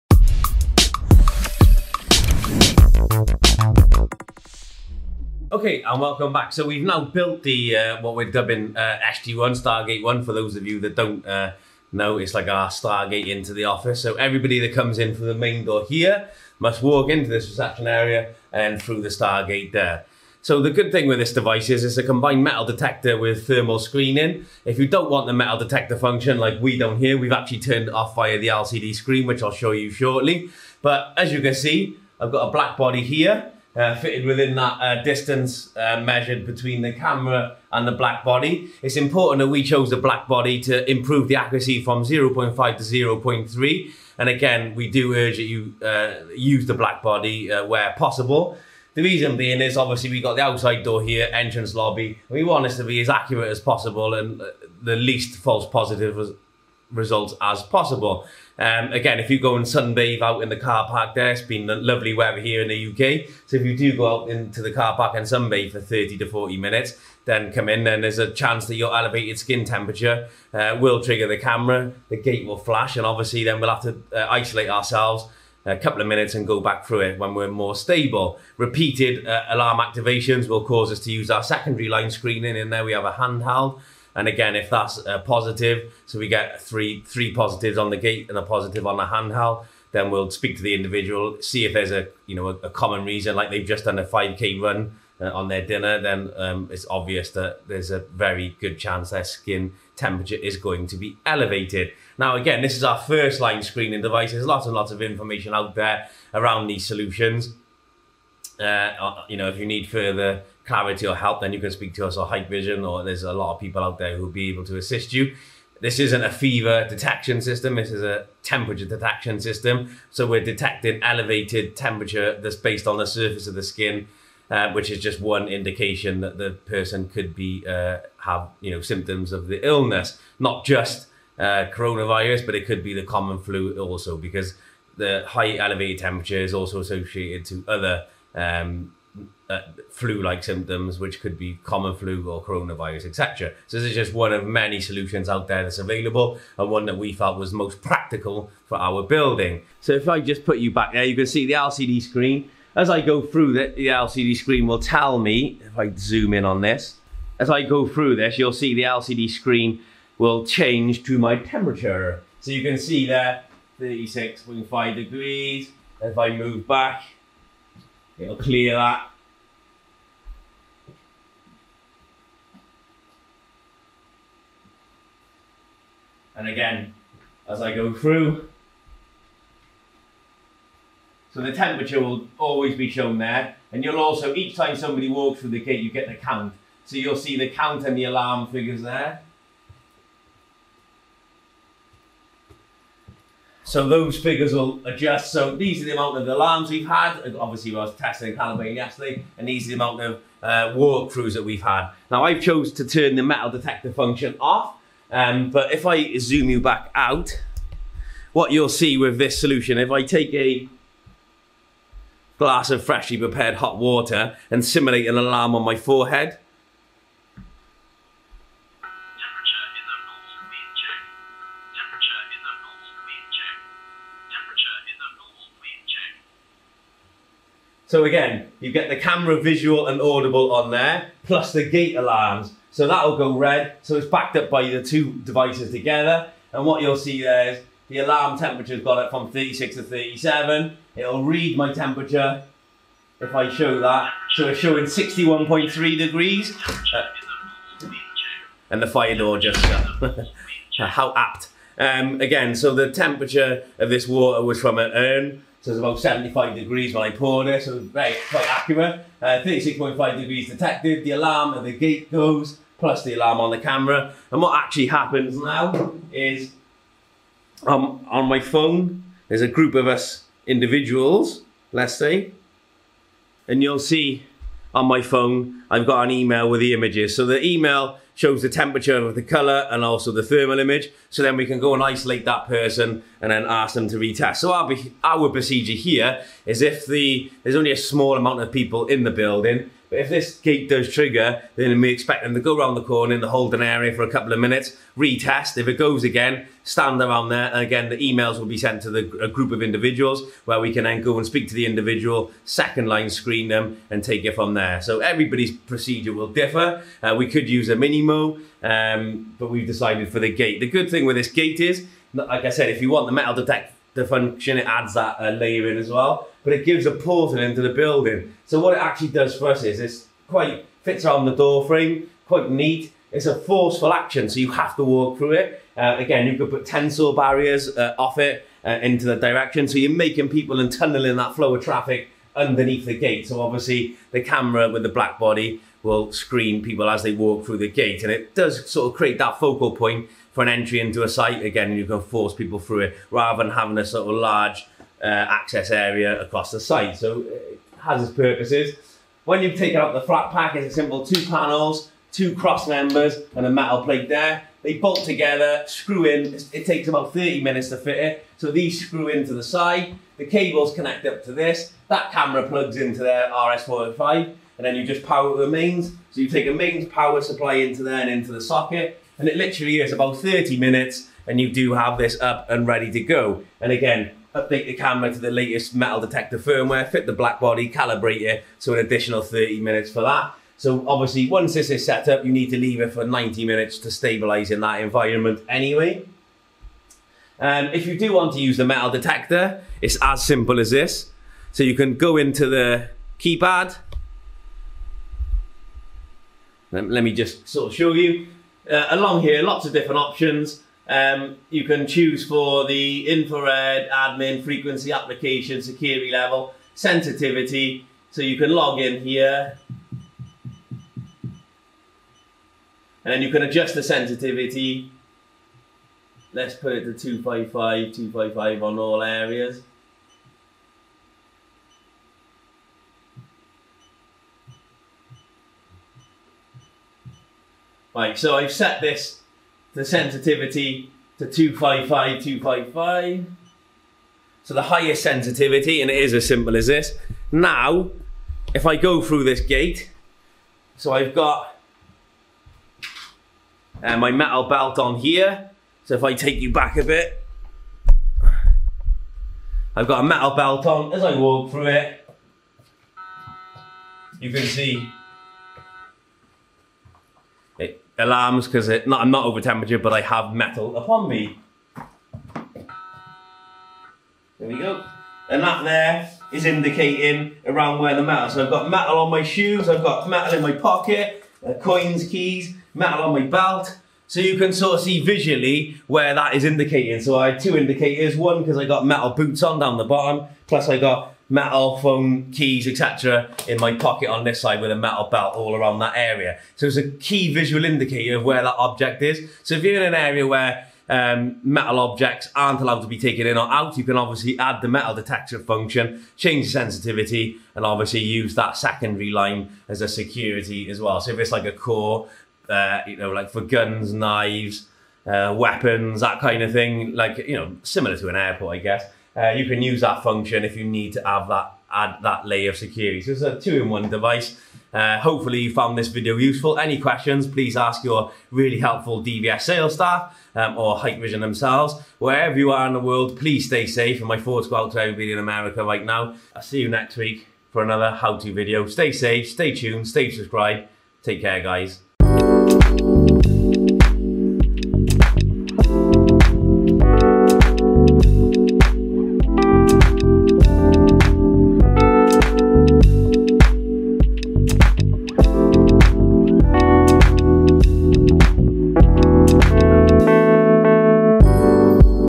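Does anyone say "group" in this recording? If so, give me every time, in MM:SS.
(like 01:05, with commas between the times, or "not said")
04:29, 04:59.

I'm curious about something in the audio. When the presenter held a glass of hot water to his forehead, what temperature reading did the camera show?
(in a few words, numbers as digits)
61.3 degrees.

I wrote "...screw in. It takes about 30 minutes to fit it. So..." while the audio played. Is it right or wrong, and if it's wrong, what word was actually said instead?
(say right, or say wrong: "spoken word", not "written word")
right.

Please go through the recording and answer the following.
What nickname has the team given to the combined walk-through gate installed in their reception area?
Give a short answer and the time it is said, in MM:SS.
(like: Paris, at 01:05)
SG1, at 00:09.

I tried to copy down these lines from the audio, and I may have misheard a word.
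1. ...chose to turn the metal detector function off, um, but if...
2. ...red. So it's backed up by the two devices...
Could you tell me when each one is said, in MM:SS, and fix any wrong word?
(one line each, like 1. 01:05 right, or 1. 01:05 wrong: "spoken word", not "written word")
1. 03:22 right
2. 03:53 right.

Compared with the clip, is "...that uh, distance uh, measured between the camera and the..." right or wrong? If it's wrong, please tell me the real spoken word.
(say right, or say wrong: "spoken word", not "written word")
right.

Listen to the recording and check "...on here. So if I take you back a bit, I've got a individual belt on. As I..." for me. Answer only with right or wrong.
wrong.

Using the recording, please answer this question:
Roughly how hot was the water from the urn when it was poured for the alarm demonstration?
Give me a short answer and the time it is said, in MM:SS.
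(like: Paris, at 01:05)
75 degrees, at 04:15.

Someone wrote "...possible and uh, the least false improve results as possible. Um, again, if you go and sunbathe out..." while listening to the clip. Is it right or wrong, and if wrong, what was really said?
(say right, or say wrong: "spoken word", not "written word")
wrong: "positive", not "improve".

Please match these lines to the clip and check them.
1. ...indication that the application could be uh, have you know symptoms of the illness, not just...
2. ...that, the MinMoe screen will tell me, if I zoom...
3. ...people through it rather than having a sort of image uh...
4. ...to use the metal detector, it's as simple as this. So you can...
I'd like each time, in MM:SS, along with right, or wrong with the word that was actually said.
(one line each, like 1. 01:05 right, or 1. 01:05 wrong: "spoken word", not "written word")
1. 02:05 wrong: "person", not "application"
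2. 02:33 wrong: "LCD", not "MinMoe"
3. 05:42 wrong: "large", not "image"
4. 06:28 right.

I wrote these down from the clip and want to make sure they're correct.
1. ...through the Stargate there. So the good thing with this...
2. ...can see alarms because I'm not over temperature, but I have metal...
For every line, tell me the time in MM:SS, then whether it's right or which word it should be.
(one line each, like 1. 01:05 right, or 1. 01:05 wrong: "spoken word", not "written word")
1. 00:18 right
2. 07:34 right.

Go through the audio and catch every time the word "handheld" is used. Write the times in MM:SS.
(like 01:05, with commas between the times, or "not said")
01:23, 01:29.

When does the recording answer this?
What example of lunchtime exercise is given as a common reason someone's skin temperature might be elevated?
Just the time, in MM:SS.
01:34.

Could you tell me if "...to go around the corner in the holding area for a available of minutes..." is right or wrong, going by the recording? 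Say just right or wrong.
wrong.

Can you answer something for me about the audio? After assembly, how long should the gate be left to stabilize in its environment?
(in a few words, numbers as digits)
90 minutes.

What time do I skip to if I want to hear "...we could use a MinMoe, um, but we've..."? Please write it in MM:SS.
05:07.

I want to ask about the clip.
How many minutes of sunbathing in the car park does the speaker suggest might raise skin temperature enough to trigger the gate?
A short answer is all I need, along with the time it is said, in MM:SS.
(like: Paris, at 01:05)
30 to 40 minutes, at 01:05.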